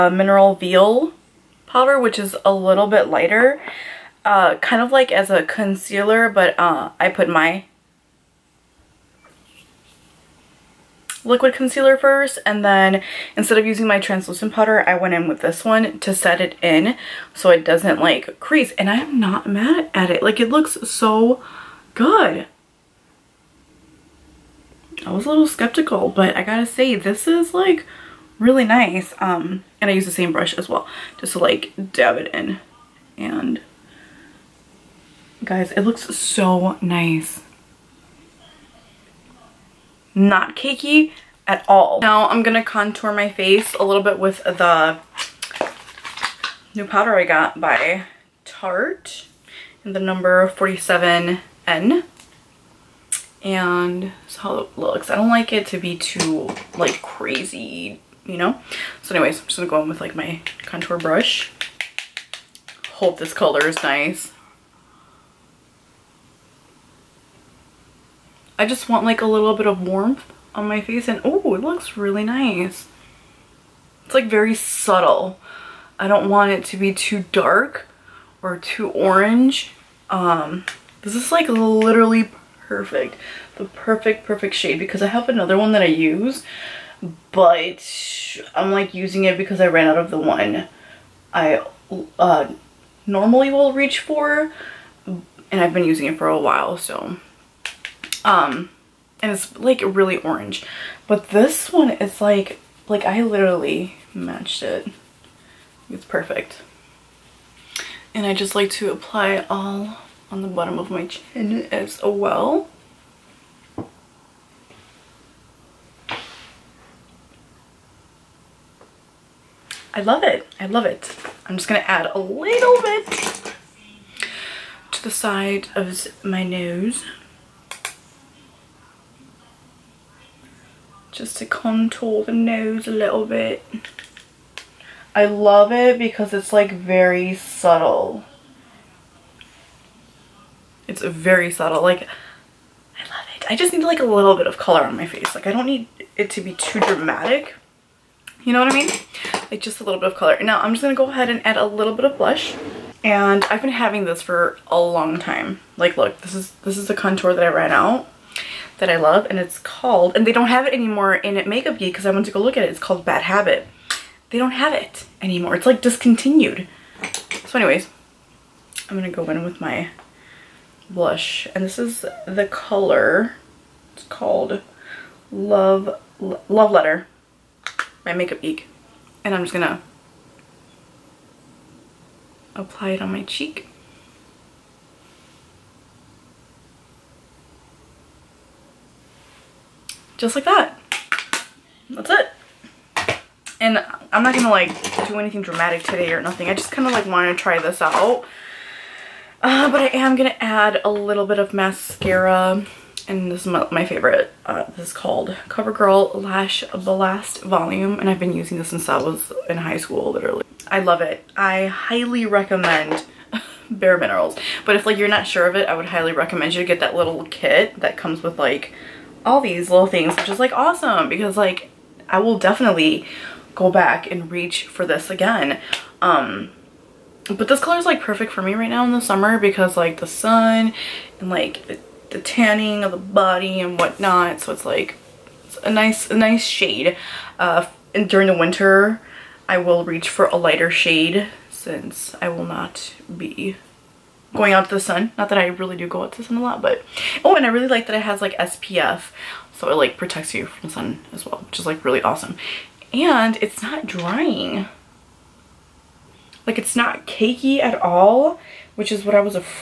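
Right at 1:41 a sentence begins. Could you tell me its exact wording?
But this one is like, like I literally matched it.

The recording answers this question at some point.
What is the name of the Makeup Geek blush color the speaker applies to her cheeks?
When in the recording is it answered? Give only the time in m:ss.
2:56.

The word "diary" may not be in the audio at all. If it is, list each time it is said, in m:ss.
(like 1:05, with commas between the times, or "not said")
not said.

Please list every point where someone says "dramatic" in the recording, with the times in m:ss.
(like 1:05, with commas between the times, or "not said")
2:26, 3:15.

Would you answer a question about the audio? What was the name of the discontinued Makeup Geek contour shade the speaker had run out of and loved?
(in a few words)
Bad Habit.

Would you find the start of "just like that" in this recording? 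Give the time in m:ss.
3:10.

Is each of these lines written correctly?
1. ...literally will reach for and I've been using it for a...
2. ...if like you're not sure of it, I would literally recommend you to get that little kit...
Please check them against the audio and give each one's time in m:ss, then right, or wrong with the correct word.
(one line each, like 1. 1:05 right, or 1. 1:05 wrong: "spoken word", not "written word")
1. 1:33 wrong: "normally", not "literally"
2. 3:34 wrong: "highly", not "literally".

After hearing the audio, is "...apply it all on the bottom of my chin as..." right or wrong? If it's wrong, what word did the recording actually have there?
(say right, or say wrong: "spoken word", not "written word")
right.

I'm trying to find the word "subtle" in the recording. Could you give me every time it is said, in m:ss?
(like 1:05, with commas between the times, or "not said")
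1:14, 2:17, 2:21.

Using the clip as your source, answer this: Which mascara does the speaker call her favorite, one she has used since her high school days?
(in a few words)
CoverGirl Lash Blast Volume.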